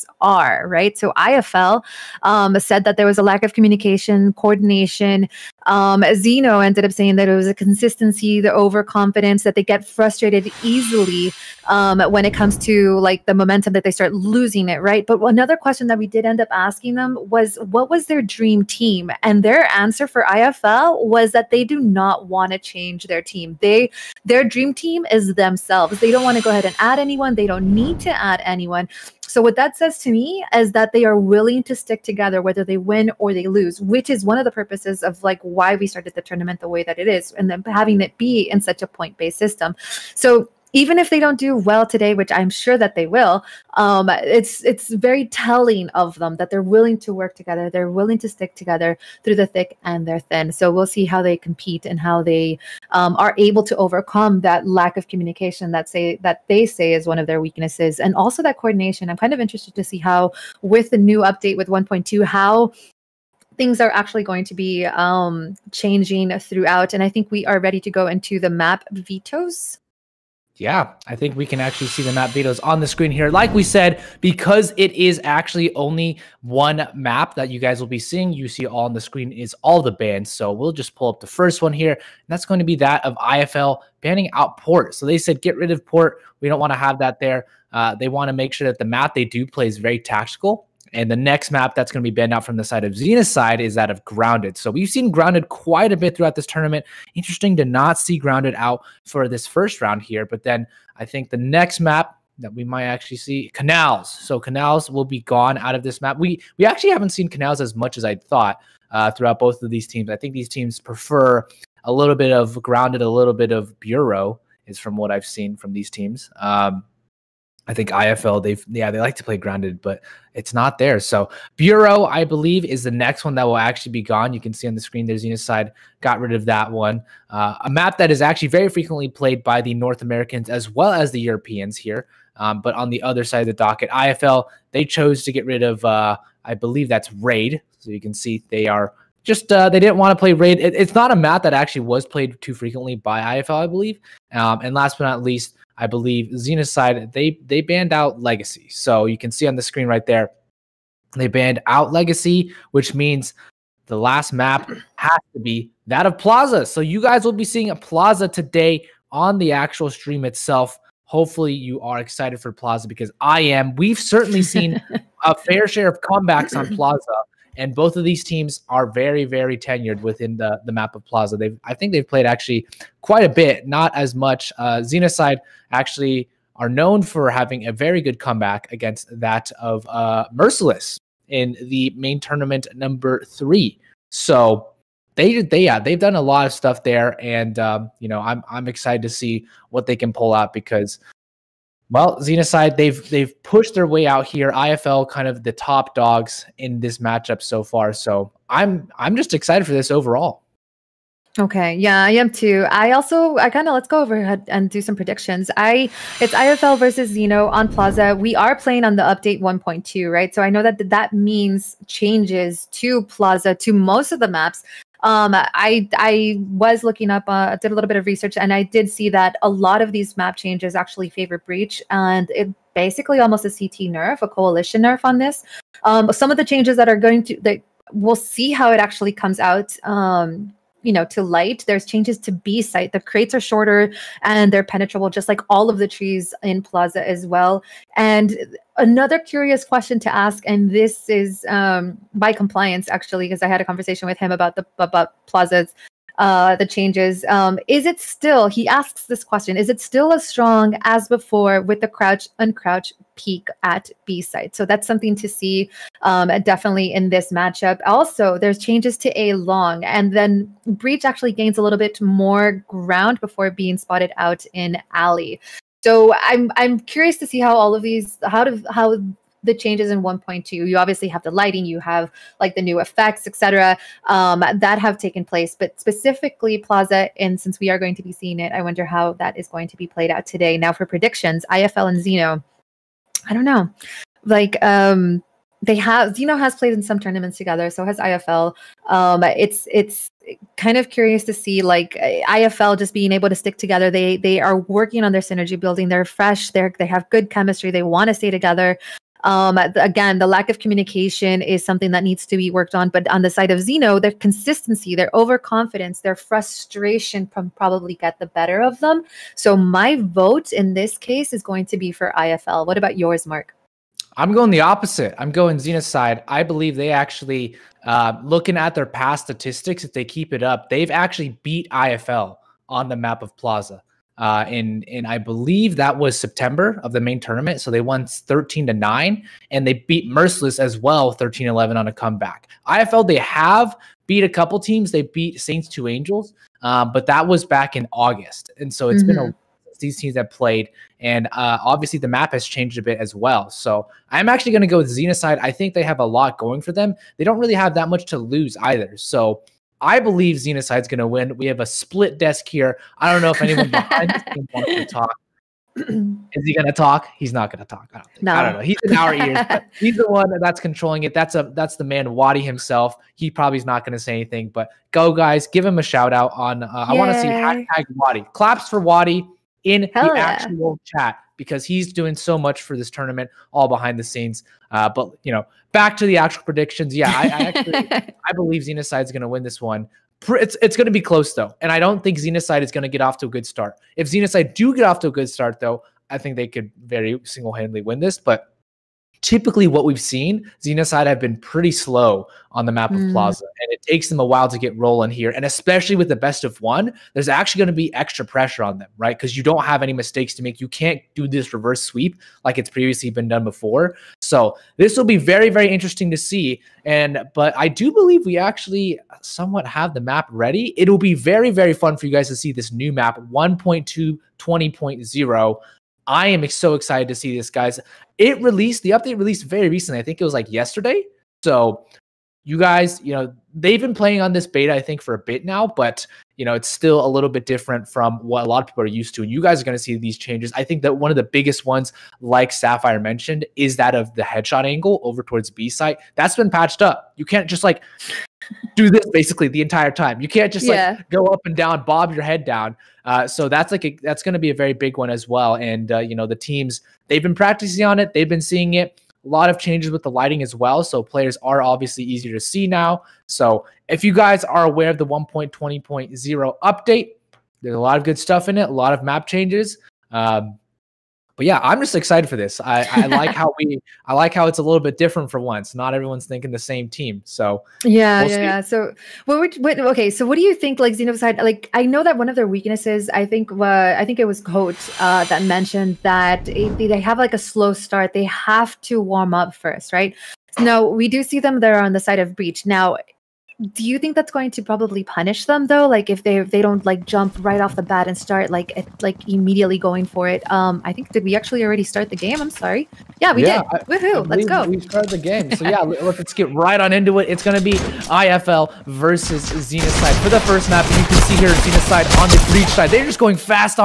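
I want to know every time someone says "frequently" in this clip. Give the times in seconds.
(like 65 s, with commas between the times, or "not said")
128 s, 142 s.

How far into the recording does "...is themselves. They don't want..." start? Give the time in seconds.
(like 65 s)
25 s.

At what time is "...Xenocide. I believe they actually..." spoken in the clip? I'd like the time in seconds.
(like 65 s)
315 s.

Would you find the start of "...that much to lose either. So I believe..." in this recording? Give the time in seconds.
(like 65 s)
347 s.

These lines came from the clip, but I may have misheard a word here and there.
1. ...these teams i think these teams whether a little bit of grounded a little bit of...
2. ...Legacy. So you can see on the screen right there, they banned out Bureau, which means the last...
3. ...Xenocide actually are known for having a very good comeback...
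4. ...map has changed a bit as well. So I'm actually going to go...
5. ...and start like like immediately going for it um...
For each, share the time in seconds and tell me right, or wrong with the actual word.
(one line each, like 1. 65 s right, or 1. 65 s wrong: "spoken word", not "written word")
1. 109 s wrong: "prefer", not "whether"
2. 148 s wrong: "Legacy", not "Bureau"
3. 174 s right
4. 342 s right
5. 488 s right.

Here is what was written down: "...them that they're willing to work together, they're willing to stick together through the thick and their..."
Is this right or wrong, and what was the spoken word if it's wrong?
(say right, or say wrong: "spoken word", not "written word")
right.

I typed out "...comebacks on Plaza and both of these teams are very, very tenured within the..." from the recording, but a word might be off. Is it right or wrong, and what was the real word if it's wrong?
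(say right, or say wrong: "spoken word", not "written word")
right.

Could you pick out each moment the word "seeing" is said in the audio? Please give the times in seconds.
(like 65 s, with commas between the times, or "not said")
77 s, 157 s, 278 s, 448 s.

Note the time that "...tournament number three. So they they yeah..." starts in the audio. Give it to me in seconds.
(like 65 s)
182 s.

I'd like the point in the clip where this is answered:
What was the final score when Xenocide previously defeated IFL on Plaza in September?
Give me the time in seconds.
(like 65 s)
328 s.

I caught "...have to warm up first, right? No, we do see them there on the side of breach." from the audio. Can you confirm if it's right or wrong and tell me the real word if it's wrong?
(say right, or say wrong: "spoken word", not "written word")
right.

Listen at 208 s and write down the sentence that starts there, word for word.
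We are playing on the update 1.2, right?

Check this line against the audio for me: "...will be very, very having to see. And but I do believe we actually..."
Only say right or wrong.
wrong.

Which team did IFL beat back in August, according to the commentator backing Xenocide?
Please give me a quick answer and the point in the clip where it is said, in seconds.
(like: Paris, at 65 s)
Saints Two Angels, at 335 s.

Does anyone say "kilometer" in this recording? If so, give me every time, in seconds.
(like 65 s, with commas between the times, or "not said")
not said.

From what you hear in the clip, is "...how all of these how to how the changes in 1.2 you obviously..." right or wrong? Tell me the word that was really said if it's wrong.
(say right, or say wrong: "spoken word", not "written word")
right.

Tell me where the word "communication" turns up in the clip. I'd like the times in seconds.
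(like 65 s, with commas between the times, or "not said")
3 s, 55 s, 300 s.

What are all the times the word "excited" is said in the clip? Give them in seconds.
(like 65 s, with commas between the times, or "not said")
161 s, 188 s, 199 s, 416 s, 461 s.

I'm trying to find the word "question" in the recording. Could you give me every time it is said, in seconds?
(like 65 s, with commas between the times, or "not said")
15 s, 239 s, 249 s.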